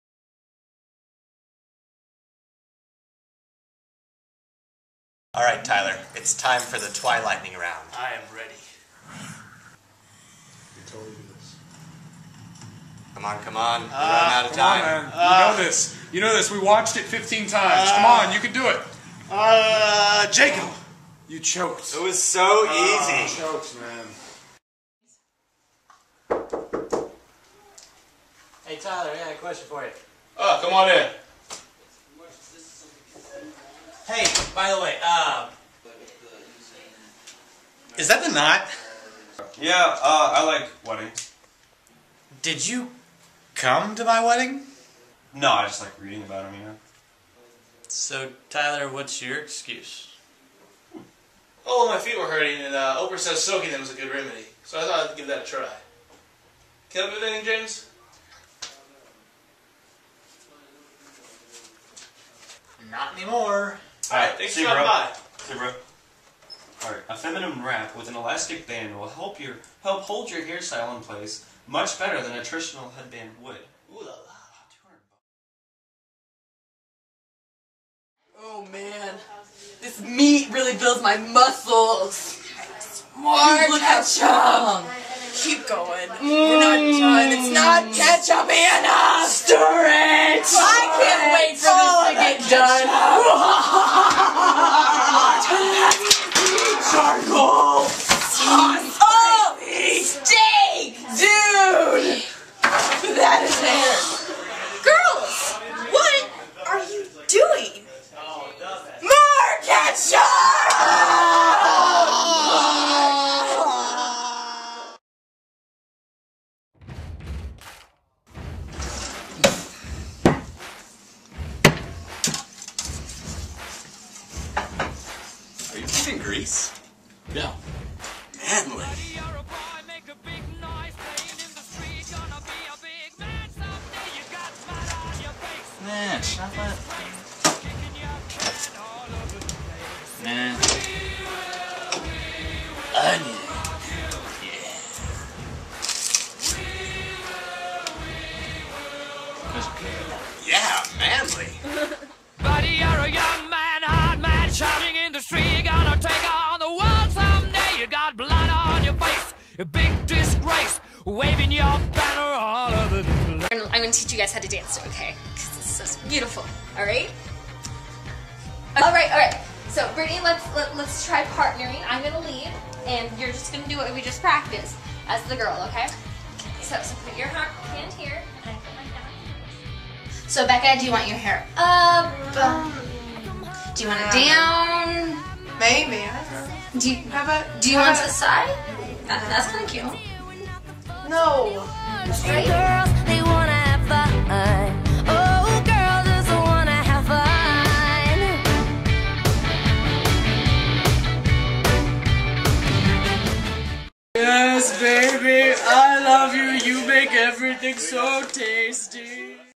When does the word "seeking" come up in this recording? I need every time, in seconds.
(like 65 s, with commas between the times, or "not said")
not said.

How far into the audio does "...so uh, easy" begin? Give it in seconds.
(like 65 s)
22 s.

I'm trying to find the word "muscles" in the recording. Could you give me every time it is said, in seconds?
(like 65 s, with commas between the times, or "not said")
81 s.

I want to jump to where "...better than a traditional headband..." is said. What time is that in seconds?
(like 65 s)
71 s.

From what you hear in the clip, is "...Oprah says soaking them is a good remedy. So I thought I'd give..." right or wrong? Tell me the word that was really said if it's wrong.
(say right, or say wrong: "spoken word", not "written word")
right.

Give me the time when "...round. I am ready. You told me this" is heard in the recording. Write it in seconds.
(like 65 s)
7 s.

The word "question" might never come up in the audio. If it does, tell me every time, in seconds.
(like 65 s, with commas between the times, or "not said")
29 s.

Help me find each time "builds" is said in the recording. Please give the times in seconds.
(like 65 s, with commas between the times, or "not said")
80 s.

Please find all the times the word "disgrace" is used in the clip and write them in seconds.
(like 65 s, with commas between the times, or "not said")
160 s.